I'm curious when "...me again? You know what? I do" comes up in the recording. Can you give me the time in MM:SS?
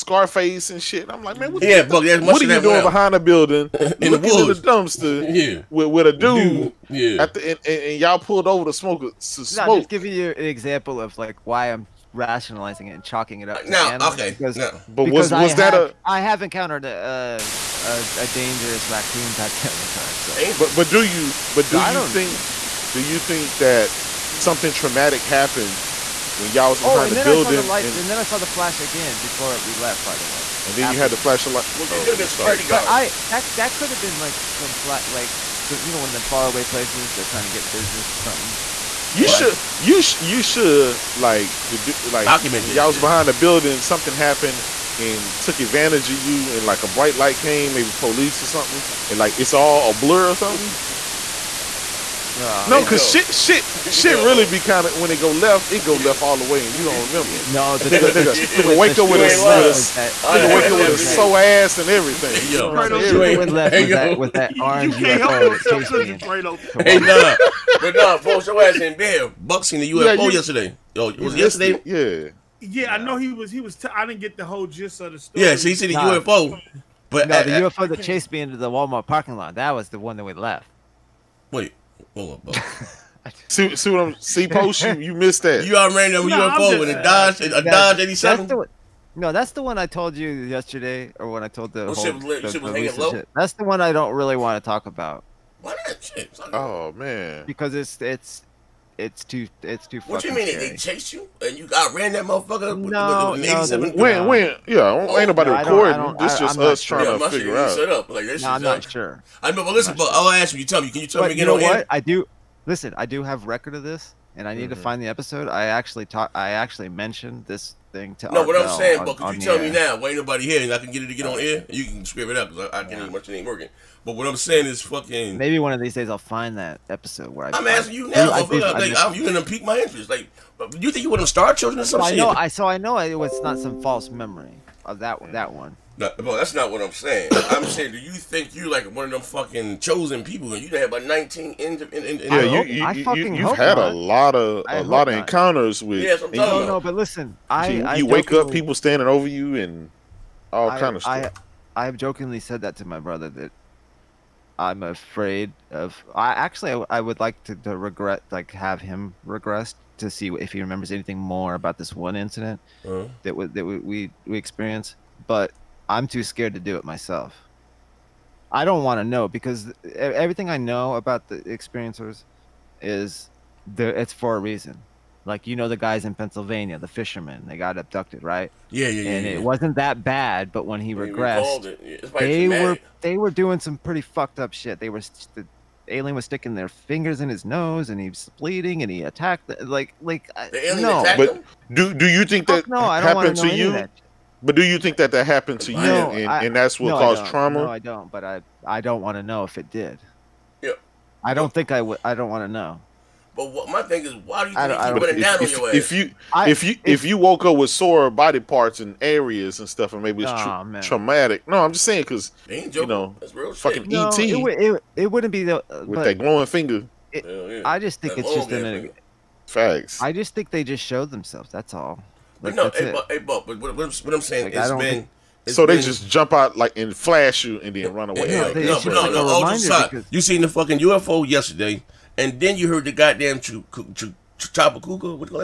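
01:51.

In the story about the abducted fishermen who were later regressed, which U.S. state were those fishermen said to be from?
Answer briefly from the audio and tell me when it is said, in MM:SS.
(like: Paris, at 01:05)
Pennsylvania, at 02:56.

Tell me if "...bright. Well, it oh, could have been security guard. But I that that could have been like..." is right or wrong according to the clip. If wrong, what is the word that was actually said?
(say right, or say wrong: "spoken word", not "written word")
wrong: "flashlight", not "bright".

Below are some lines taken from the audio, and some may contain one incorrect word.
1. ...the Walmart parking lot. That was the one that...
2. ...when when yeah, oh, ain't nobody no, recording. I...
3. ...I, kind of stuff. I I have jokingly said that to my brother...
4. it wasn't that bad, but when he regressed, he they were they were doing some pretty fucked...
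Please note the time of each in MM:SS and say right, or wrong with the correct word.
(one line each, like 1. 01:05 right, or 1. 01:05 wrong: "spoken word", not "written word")
1. 01:18 right
2. 01:44 right
3. 02:30 right
4. 02:59 right.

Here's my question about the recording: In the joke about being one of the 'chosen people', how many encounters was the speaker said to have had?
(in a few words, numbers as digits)
19.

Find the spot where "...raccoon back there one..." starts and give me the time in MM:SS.
00:18.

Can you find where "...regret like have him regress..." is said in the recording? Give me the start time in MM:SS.
02:37.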